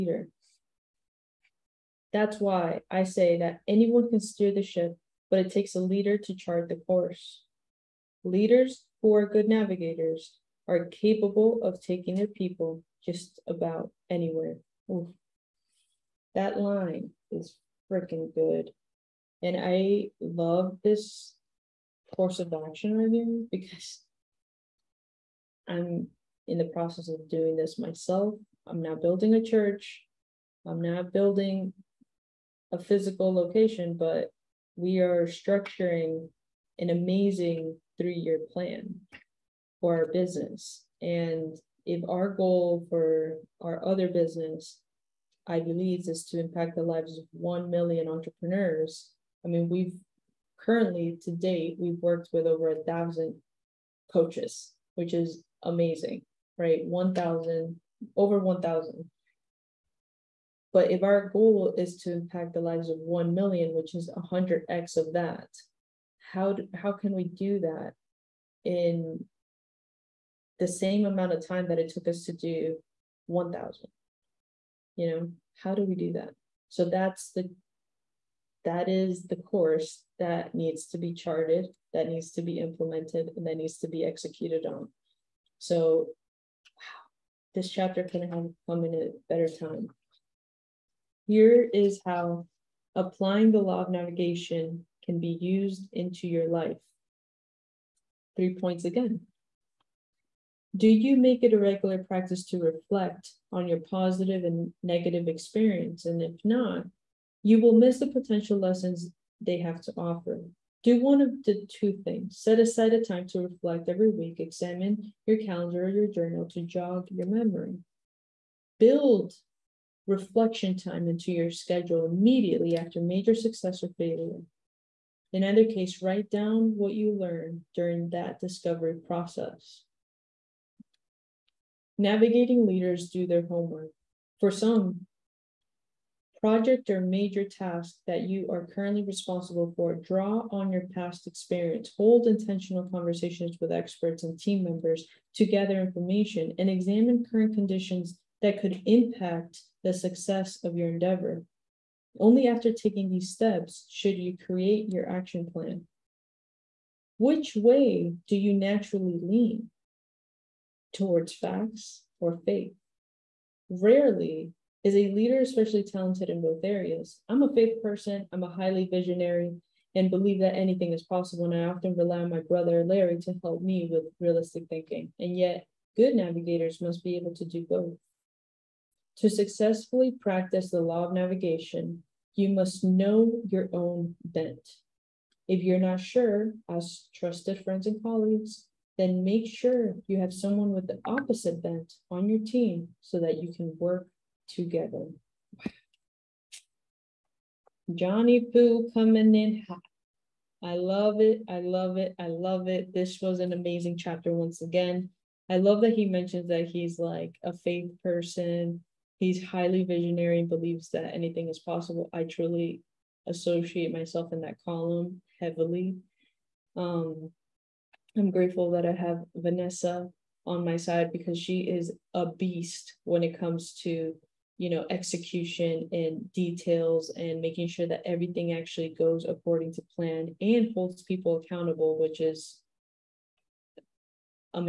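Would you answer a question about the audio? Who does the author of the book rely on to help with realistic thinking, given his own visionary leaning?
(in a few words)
Larry.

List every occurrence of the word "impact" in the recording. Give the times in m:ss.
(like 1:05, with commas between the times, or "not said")
0:46, 1:02, 2:28.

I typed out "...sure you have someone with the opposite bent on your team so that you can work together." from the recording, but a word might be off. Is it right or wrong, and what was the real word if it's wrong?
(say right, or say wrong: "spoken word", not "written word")
right.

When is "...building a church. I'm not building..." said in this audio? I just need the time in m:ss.
0:29.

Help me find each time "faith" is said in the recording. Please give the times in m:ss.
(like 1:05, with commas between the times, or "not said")
2:42, 2:47, 3:27.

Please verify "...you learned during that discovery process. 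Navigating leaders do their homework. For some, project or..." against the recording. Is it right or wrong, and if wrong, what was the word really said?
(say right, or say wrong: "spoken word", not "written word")
right.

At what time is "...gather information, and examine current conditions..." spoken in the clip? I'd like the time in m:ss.
2:25.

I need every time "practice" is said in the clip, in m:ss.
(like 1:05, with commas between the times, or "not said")
1:42, 3:00.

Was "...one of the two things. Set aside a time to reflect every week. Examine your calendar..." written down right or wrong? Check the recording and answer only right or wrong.
right.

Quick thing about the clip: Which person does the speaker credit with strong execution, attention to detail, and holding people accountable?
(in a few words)
Vanessa.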